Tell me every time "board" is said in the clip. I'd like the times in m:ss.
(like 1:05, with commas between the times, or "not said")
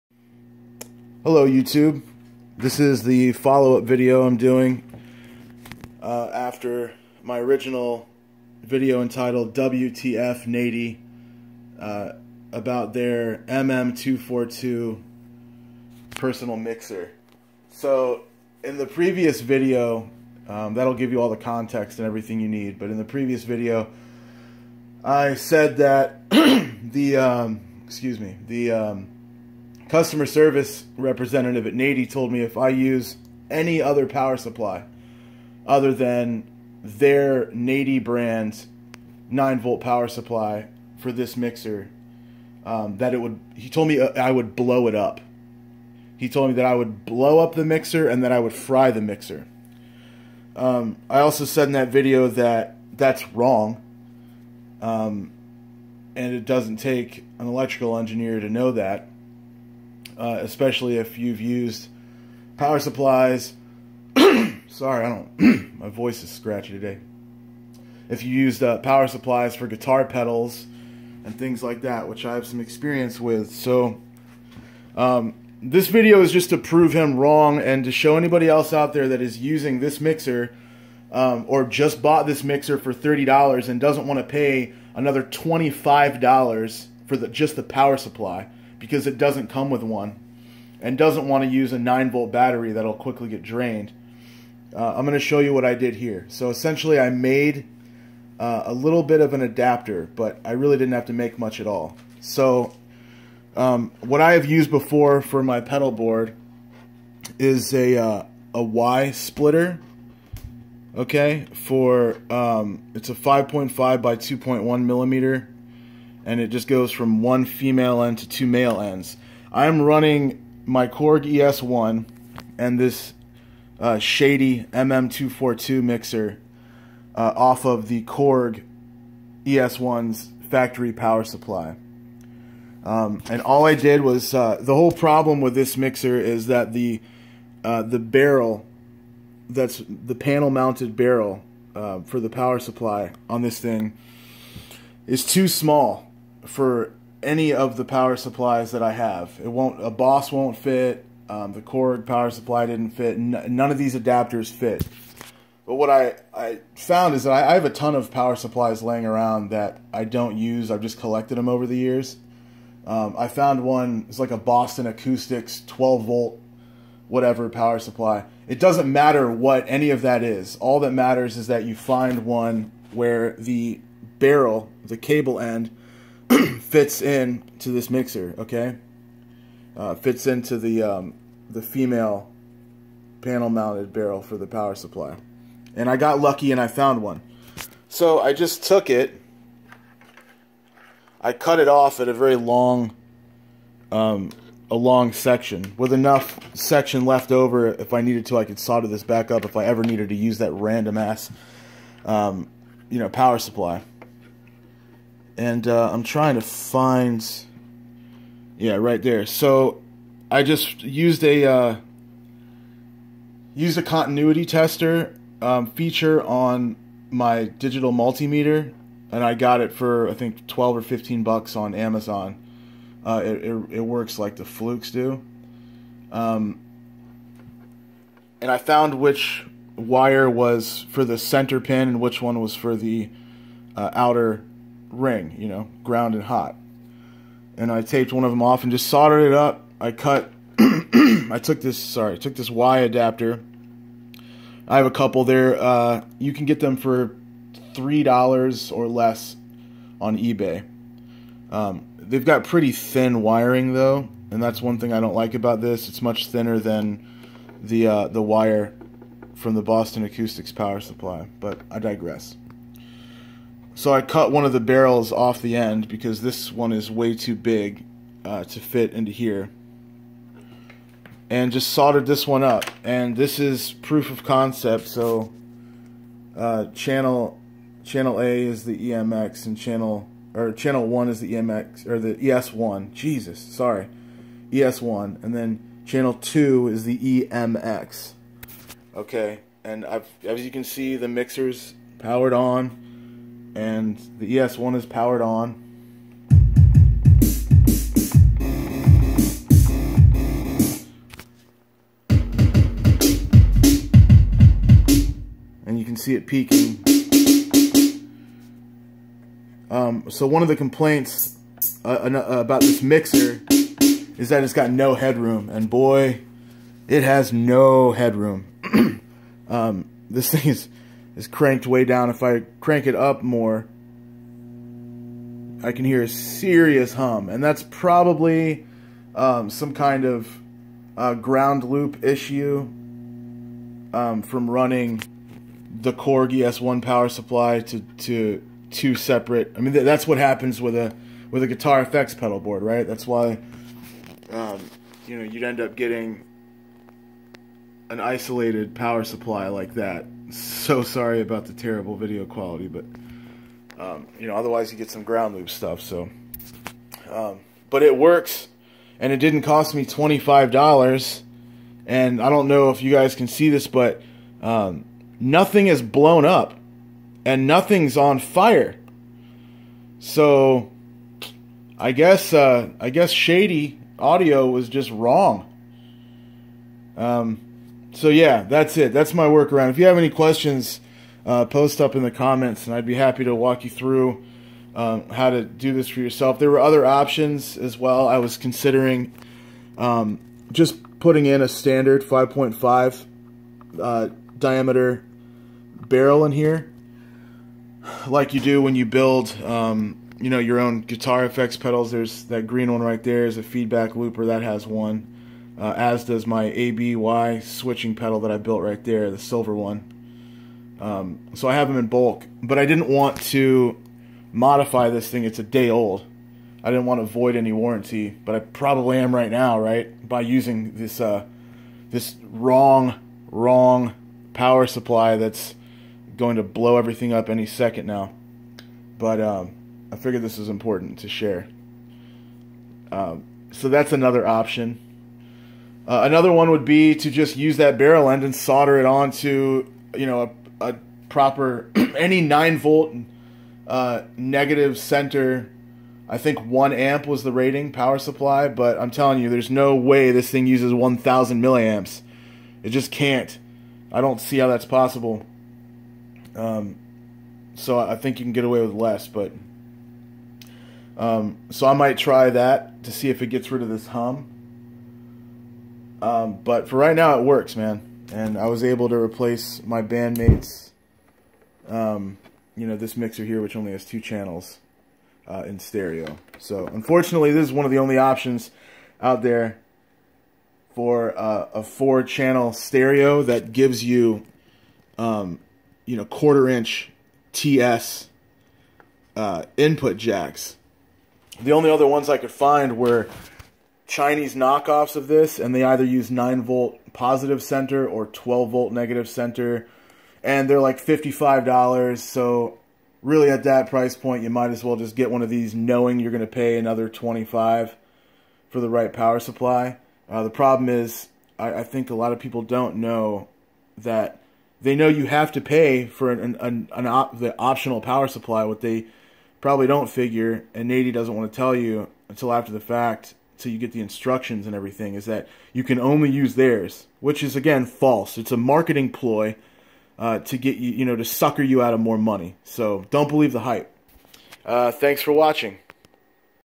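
1:45, 5:42.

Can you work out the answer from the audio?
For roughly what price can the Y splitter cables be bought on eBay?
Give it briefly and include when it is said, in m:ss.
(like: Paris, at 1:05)
$3 or less, at 4:07.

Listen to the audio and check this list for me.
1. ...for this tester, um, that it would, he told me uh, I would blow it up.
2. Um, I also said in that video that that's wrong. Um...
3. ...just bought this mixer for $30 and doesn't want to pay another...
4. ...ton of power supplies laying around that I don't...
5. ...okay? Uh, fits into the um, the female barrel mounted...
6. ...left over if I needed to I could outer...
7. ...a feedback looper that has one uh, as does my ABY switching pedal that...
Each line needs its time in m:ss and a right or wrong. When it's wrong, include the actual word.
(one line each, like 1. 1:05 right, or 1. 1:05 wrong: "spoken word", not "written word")
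1. 0:40 wrong: "mixer", not "tester"
2. 0:50 right
3. 1:21 right
4. 2:37 right
5. 2:58 wrong: "panel", not "barrel"
6. 3:17 wrong: "solder", not "outer"
7. 6:43 right.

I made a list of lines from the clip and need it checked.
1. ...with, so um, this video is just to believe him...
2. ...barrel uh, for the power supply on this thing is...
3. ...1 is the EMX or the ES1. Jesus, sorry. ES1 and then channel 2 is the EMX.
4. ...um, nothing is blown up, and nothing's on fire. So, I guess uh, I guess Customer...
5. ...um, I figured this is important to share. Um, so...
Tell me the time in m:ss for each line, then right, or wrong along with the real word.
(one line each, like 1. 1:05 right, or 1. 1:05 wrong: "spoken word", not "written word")
1. 1:13 wrong: "prove", not "believe"
2. 2:20 right
3. 4:40 right
4. 6:04 wrong: "Shady", not "Customer"
5. 7:09 right.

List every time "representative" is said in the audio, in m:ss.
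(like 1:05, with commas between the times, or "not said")
0:30.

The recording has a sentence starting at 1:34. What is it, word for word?
Uh, I'm going to show you what I did here.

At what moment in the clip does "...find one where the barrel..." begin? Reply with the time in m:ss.
2:51.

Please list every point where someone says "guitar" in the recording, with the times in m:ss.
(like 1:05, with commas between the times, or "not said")
1:09, 5:41, 6:40.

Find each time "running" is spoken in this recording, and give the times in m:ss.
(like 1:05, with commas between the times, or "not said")
1:59, 5:34.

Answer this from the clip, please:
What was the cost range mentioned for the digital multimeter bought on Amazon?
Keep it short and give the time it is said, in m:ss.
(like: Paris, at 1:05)
12 or 15 bucks, at 3:40.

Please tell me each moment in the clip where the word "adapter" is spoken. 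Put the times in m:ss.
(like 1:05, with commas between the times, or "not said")
1:39, 2:33, 4:02.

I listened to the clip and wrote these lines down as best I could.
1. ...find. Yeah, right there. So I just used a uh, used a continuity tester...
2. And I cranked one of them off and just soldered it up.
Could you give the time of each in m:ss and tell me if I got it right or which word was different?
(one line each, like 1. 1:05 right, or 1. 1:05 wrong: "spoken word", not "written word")
1. 3:26 right
2. 3:57 wrong: "taped", not "cranked".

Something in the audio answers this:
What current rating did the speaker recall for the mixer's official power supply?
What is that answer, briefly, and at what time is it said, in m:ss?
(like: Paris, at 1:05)
1 amp, at 7:26.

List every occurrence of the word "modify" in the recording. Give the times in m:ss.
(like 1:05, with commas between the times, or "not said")
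6:54.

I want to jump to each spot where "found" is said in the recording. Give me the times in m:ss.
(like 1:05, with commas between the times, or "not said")
2:36, 2:43, 3:06, 3:48.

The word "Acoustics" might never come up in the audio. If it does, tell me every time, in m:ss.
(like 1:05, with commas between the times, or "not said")
2:44, 4:20.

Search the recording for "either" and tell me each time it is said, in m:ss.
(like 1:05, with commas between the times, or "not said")
8:15.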